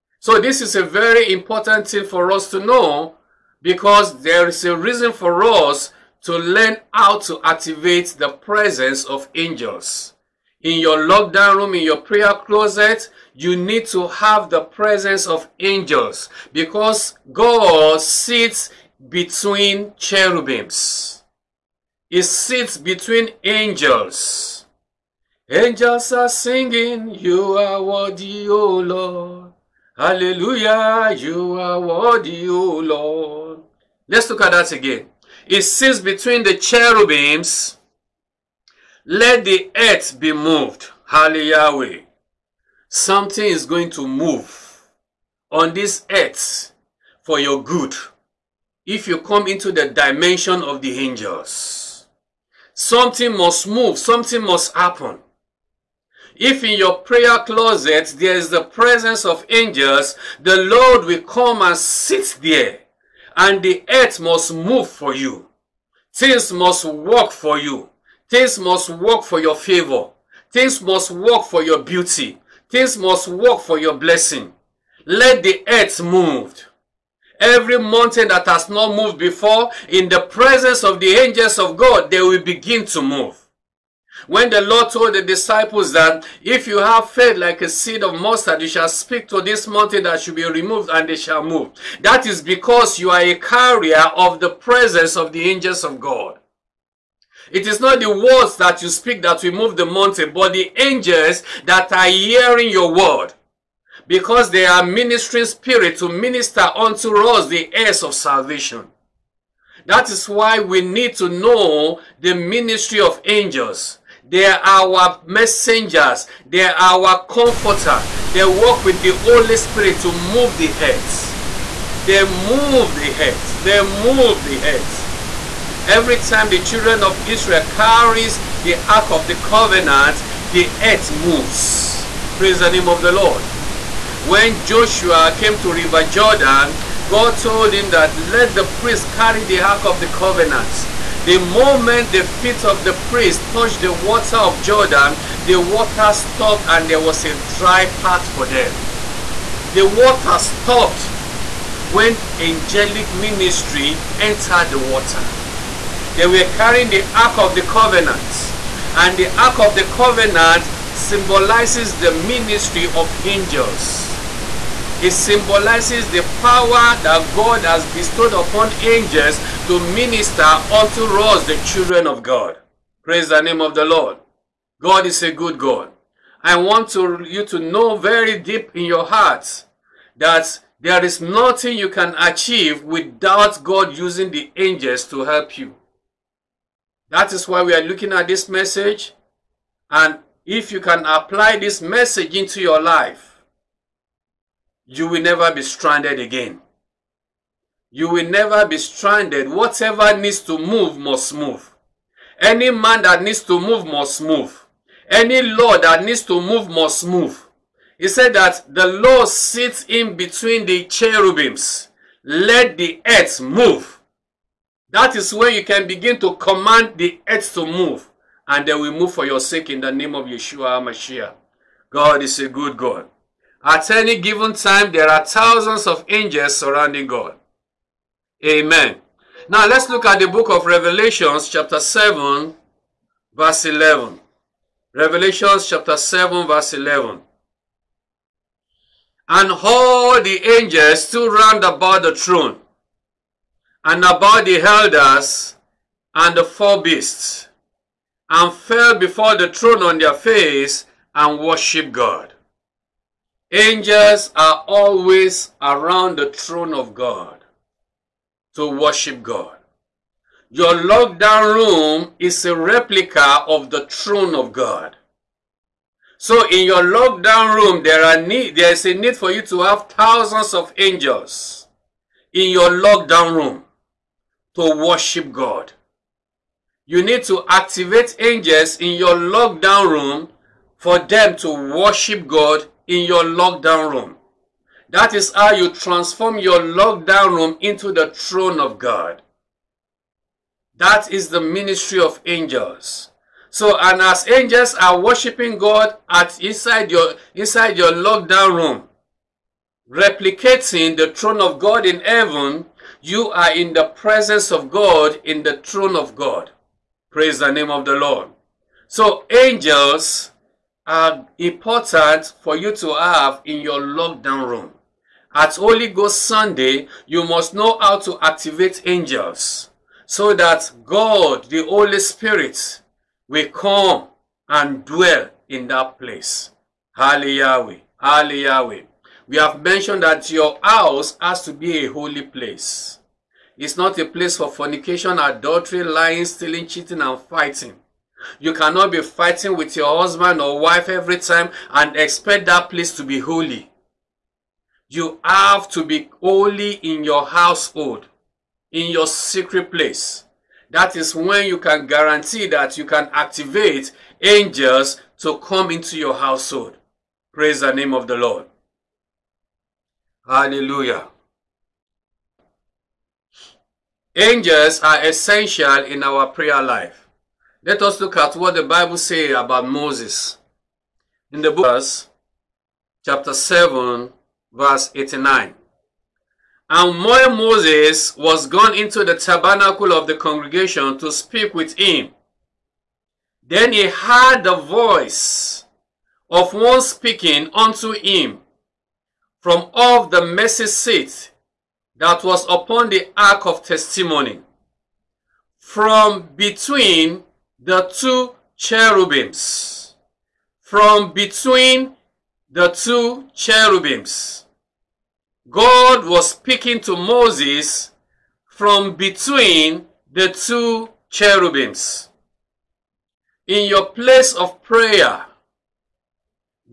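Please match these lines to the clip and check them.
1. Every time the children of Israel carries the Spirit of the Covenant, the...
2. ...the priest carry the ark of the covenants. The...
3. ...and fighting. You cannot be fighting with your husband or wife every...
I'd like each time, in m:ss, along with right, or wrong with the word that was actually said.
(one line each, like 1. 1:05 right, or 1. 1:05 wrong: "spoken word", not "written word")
1. 2:05 wrong: "Ark", not "Spirit"
2. 2:18 right
3. 5:37 right.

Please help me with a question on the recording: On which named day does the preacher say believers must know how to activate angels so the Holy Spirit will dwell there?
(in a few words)
Holy Ghost Sunday.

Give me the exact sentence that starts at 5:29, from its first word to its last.
We have mentioned that your house has to be a holy place.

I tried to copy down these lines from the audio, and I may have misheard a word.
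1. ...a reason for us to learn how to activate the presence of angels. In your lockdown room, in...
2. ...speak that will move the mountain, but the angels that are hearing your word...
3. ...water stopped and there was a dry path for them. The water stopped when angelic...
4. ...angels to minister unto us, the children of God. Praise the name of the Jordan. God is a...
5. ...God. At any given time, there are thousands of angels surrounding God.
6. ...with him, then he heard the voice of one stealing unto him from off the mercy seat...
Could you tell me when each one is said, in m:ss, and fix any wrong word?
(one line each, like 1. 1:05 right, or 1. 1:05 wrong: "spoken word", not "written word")
1. 0:04 right
2. 1:38 right
3. 2:25 right
4. 2:48 wrong: "Lord", not "Jordan"
5. 3:42 right
6. 6:21 wrong: "speaking", not "stealing".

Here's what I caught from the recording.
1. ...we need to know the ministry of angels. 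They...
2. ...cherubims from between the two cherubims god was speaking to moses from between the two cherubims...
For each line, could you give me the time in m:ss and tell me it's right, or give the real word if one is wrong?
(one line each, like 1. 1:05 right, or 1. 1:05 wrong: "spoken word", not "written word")
1. 1:50 right
2. 6:38 right.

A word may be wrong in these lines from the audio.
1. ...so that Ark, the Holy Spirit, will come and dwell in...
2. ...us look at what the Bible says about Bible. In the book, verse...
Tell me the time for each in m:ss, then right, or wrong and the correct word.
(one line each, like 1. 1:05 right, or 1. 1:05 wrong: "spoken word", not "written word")
1. 5:20 wrong: "God", not "Ark"
2. 6:07 wrong: "Moses", not "Bible".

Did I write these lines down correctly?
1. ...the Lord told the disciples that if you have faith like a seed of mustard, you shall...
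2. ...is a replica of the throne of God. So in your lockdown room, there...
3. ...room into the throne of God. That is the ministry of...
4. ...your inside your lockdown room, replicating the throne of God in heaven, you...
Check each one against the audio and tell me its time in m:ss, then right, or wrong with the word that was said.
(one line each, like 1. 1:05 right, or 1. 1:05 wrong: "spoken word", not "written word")
1. 1:24 right
2. 4:22 right
3. 4:47 right
4. 4:56 right.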